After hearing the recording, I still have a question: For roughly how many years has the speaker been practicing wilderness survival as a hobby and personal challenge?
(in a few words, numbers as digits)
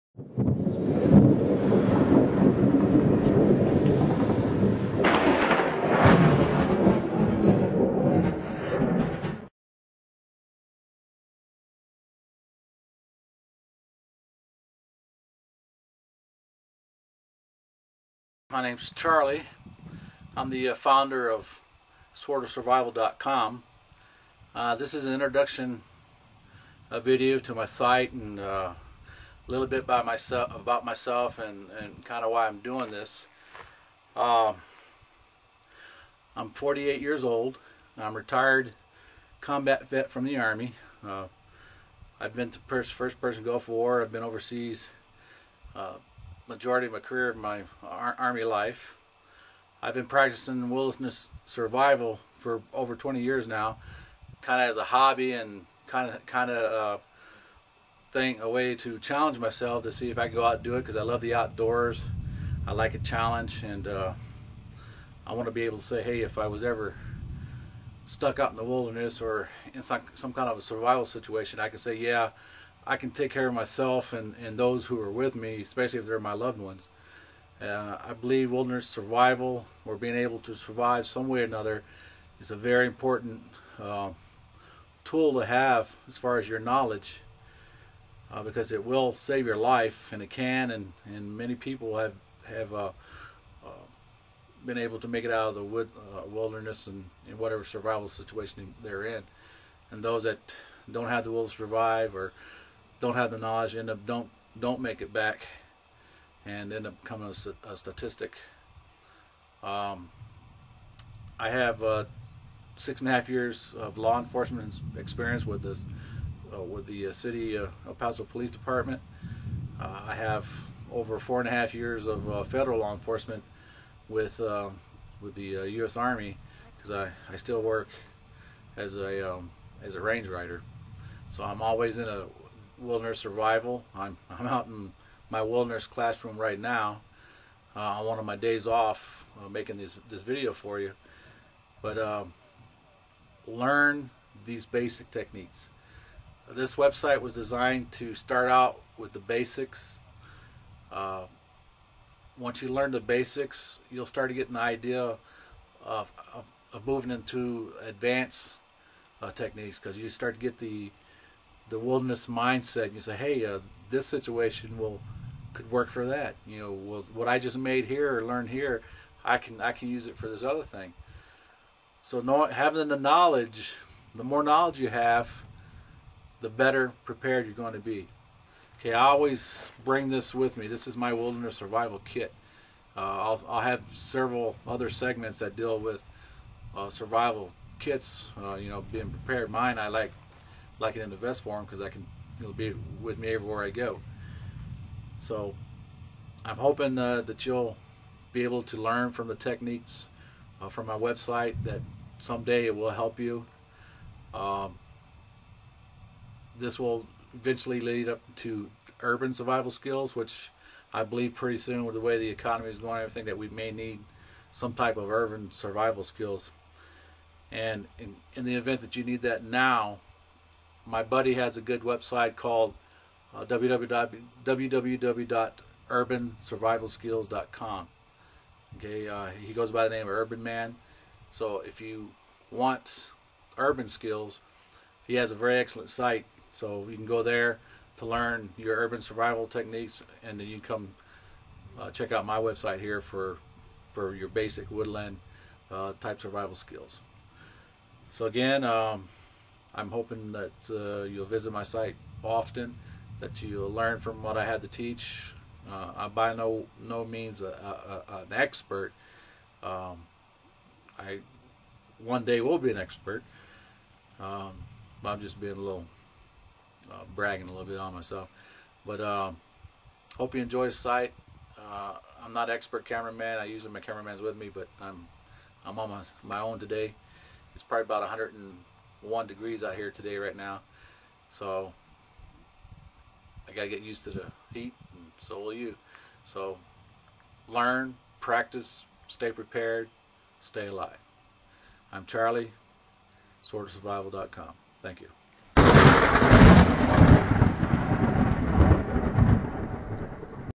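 Over 20.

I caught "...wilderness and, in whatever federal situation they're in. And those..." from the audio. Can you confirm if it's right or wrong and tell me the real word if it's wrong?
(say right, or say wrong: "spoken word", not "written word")
wrong: "survival", not "federal".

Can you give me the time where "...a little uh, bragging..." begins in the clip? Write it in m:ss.
4:25.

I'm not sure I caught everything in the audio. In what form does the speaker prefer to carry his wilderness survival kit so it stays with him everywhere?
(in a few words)
Vest.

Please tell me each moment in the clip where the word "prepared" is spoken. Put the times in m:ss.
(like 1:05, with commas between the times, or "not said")
2:57, 3:09, 4:49.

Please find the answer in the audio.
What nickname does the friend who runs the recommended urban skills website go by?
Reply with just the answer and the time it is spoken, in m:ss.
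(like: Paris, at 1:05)
Urban Man, at 3:50.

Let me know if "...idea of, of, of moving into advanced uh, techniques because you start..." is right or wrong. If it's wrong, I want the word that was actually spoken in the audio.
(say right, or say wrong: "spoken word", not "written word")
right.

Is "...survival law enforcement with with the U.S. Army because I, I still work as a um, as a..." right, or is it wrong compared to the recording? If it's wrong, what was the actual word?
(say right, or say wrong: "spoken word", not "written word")
wrong: "federal", not "survival".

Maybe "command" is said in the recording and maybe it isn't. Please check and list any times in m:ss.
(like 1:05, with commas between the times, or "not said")
not said.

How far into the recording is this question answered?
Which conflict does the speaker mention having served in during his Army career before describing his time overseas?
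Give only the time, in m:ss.
0:43.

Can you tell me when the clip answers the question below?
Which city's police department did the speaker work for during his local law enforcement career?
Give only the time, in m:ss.
1:57.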